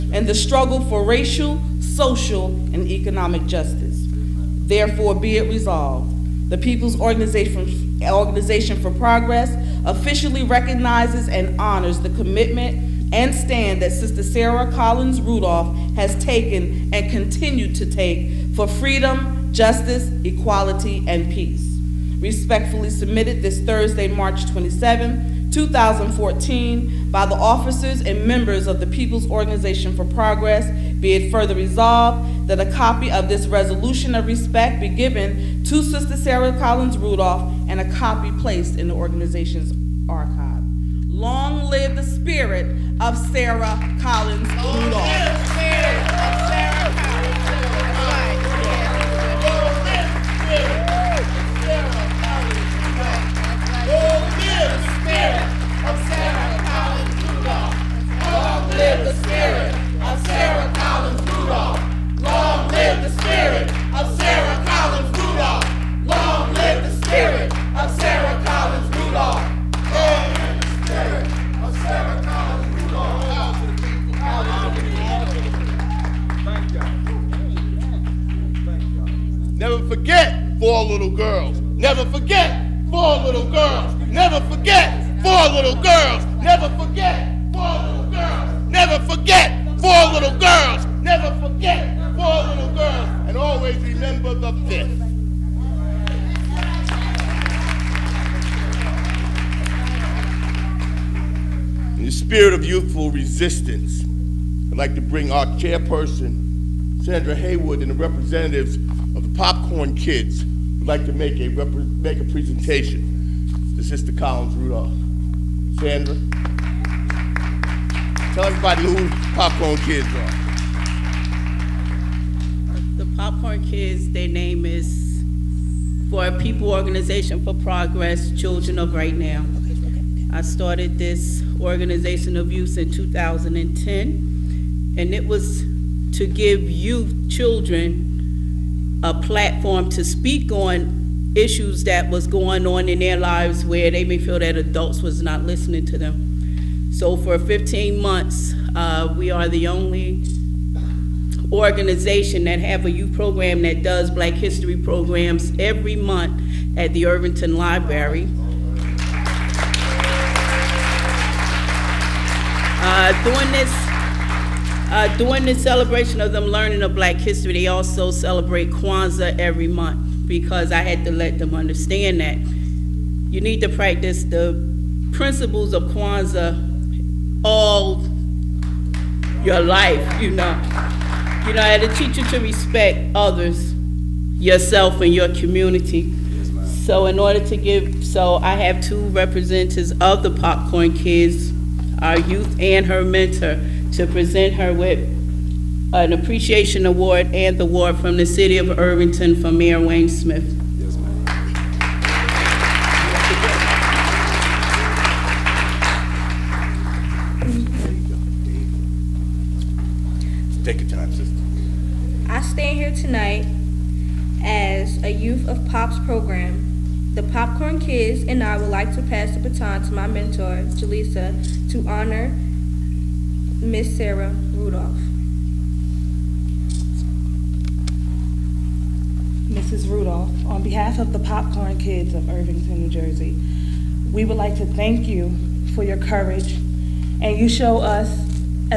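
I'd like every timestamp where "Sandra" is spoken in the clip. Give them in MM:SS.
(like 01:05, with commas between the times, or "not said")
01:46, 01:55.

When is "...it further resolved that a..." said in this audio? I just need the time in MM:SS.
00:31.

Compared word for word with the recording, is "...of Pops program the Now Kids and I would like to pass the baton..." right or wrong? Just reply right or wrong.
wrong.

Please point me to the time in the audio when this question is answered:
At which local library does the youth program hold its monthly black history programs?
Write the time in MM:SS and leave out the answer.
02:37.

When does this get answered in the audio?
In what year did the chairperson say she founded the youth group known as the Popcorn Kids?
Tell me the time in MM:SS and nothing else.
02:12.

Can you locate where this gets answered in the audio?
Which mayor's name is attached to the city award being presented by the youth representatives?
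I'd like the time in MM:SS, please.
03:19.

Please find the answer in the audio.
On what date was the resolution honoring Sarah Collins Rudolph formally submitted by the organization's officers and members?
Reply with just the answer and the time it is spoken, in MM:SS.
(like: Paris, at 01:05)
March 27, 2014, at 00:24.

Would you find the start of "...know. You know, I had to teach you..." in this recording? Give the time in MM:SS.
03:00.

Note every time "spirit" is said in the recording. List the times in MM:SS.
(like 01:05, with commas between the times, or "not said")
00:42, 01:42.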